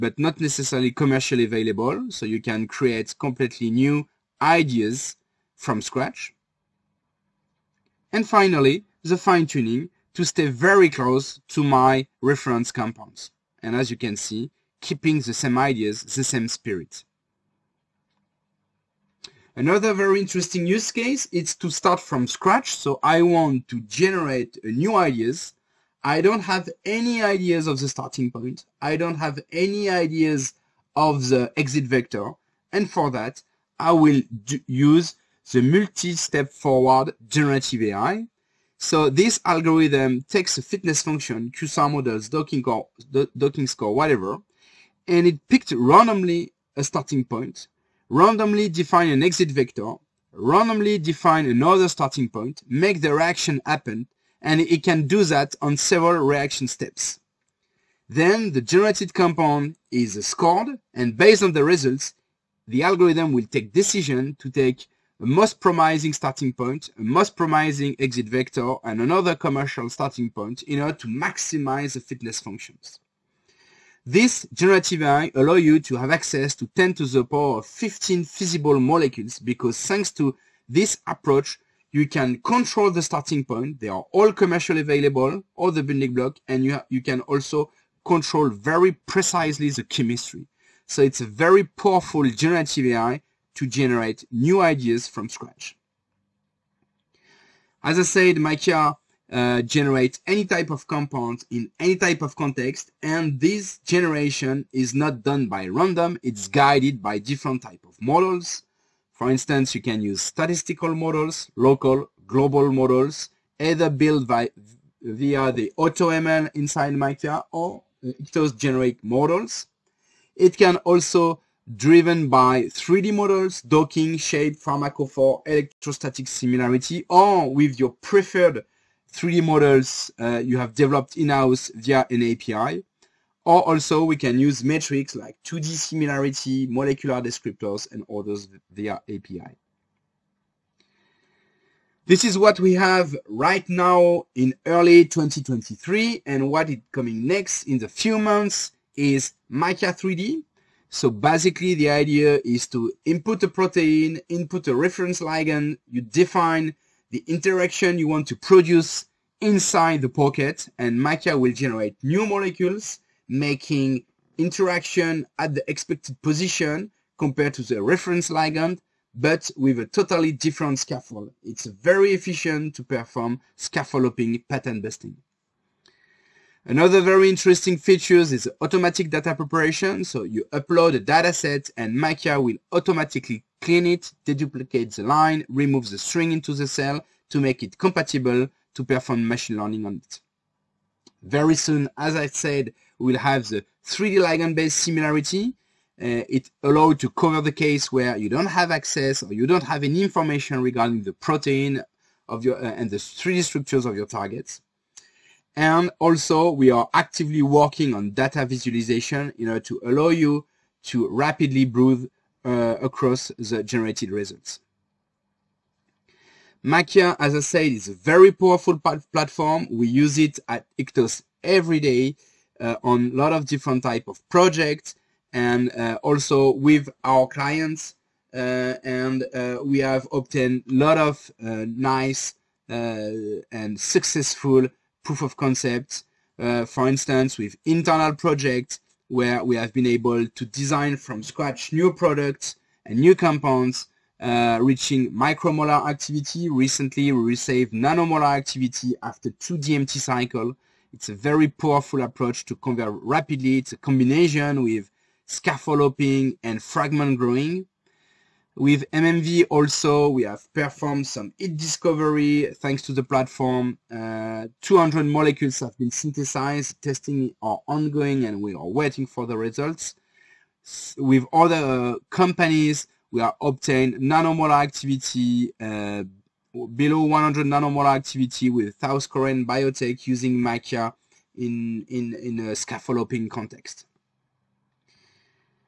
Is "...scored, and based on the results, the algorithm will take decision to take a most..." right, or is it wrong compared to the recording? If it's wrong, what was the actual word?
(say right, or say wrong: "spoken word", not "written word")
right.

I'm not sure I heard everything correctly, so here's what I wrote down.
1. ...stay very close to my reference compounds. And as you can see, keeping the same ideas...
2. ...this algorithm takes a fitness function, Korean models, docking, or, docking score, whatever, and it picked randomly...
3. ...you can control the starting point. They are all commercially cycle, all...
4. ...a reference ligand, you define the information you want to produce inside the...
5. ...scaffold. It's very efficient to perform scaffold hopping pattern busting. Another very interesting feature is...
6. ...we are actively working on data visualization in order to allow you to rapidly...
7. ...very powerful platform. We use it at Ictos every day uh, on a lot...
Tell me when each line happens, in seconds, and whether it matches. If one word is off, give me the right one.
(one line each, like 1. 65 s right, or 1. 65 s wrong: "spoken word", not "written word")
1. 10 s right
2. 39 s wrong: "QSAR", not "Korean"
3. 81 s wrong: "available", not "cycle"
4. 154 s wrong: "interaction", not "information"
5. 170 s right
6. 206 s right
7. 217 s right.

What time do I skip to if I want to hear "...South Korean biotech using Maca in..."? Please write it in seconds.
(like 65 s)
278 s.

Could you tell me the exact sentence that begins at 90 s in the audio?
So it's a very powerful generative AI to generate new ideas from scratch.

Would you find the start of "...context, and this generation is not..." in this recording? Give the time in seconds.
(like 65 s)
102 s.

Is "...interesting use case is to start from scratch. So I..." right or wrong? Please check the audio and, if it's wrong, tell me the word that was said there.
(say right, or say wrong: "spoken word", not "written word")
right.